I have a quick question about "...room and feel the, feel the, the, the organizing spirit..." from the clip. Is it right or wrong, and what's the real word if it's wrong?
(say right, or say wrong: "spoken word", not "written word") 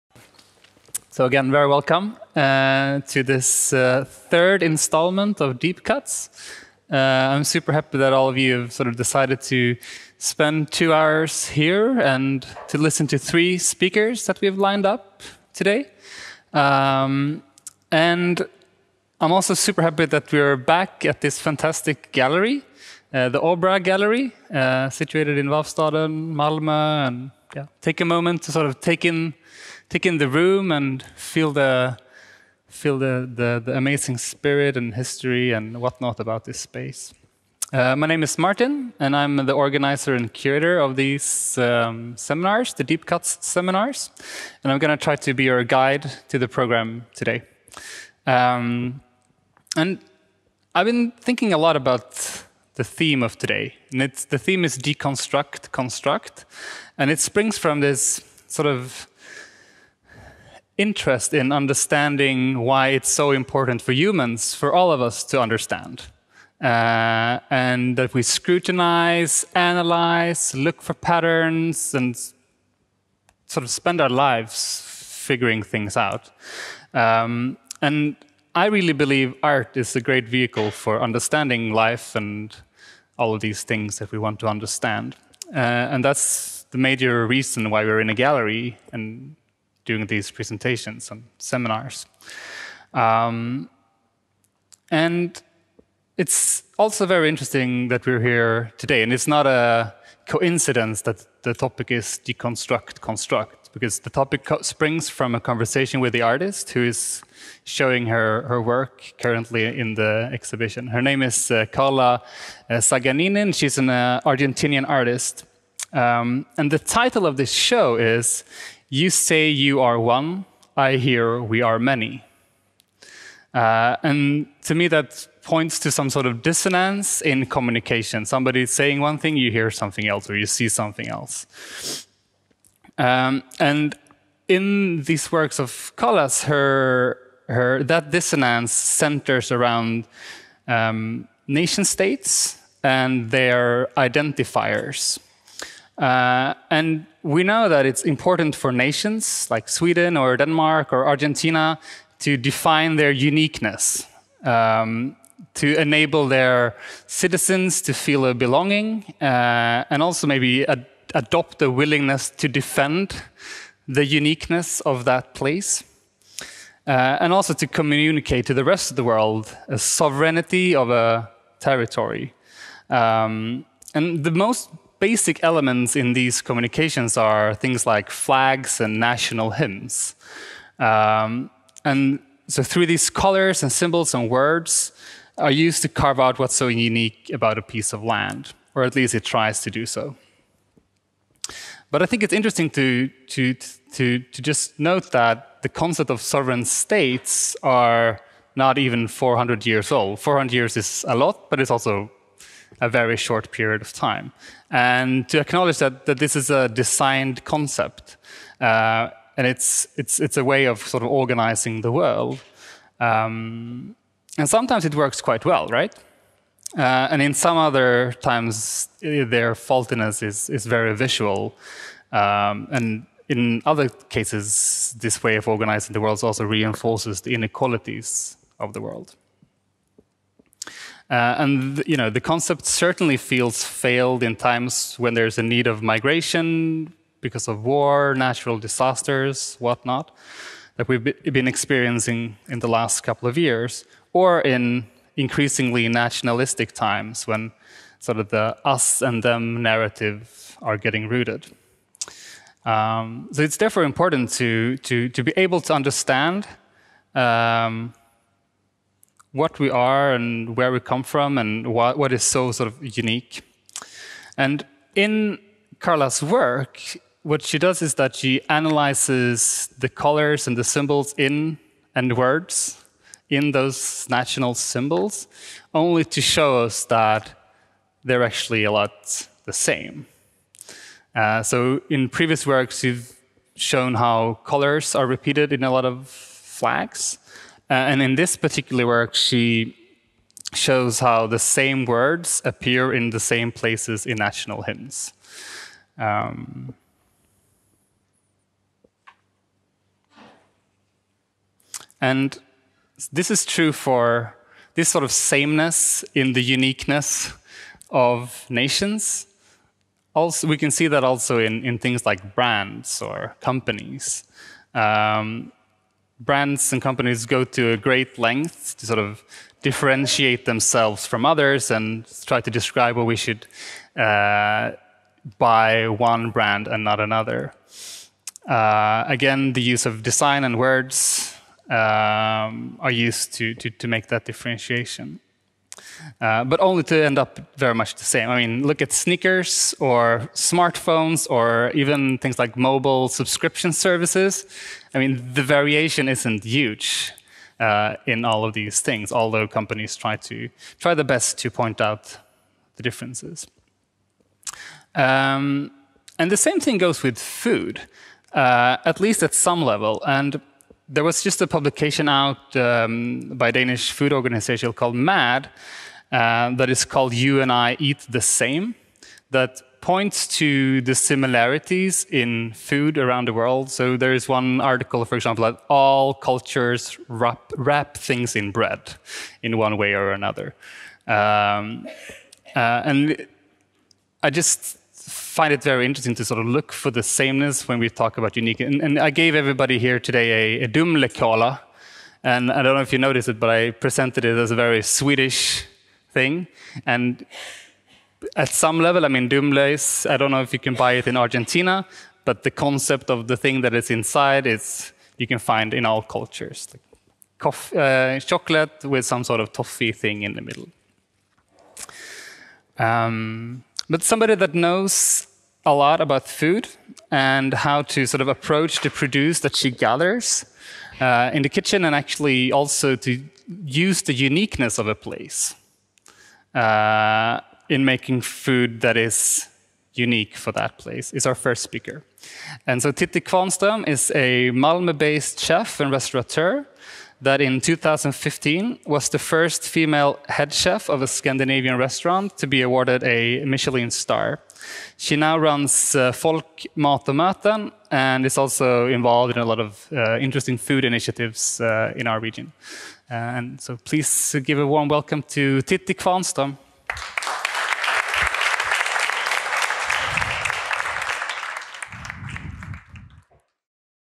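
wrong: "amazing", not "organizing".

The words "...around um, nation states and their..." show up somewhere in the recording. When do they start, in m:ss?
2:19.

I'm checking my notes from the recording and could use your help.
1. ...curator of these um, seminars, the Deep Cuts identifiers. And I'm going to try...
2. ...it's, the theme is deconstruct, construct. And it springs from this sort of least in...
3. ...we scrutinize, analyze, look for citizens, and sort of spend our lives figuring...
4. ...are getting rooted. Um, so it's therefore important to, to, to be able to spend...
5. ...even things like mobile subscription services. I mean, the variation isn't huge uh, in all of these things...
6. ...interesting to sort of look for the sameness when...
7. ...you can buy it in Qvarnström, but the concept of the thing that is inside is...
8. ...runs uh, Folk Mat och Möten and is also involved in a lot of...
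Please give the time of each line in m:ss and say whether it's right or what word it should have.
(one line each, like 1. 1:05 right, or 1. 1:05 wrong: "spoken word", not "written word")
1. 0:40 wrong: "seminars", not "identifiers"
2. 0:54 wrong: "interest", not "least"
3. 1:08 wrong: "patterns", not "citizens"
4. 4:10 wrong: "understand", not "spend"
5. 5:41 right
6. 6:25 right
7. 6:40 wrong: "Argentina", not "Qvarnström"
8. 7:25 right.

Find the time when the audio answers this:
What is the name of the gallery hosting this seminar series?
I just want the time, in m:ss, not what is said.
0:23.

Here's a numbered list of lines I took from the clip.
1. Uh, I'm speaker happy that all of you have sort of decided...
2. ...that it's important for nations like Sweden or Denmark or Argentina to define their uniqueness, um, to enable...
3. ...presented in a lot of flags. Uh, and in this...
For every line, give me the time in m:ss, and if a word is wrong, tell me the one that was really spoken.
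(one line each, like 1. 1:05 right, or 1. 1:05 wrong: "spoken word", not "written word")
1. 0:06 wrong: "super", not "speaker"
2. 2:27 right
3. 4:45 wrong: "repeated", not "presented".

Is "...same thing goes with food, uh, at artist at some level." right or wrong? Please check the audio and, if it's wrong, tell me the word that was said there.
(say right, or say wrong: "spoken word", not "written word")
wrong: "least", not "artist".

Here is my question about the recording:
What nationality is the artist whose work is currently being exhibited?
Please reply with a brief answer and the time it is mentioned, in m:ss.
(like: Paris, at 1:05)
Argentinian, at 1:54.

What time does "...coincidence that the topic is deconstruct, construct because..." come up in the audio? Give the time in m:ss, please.
1:40.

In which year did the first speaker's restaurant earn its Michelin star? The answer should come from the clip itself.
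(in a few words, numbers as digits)
2015.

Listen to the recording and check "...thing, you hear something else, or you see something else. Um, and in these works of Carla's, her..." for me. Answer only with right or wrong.
right.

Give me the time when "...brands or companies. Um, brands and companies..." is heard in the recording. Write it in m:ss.
5:12.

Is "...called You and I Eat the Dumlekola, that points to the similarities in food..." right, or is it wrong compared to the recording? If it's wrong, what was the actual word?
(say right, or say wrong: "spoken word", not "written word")
wrong: "Same", not "Dumlekola".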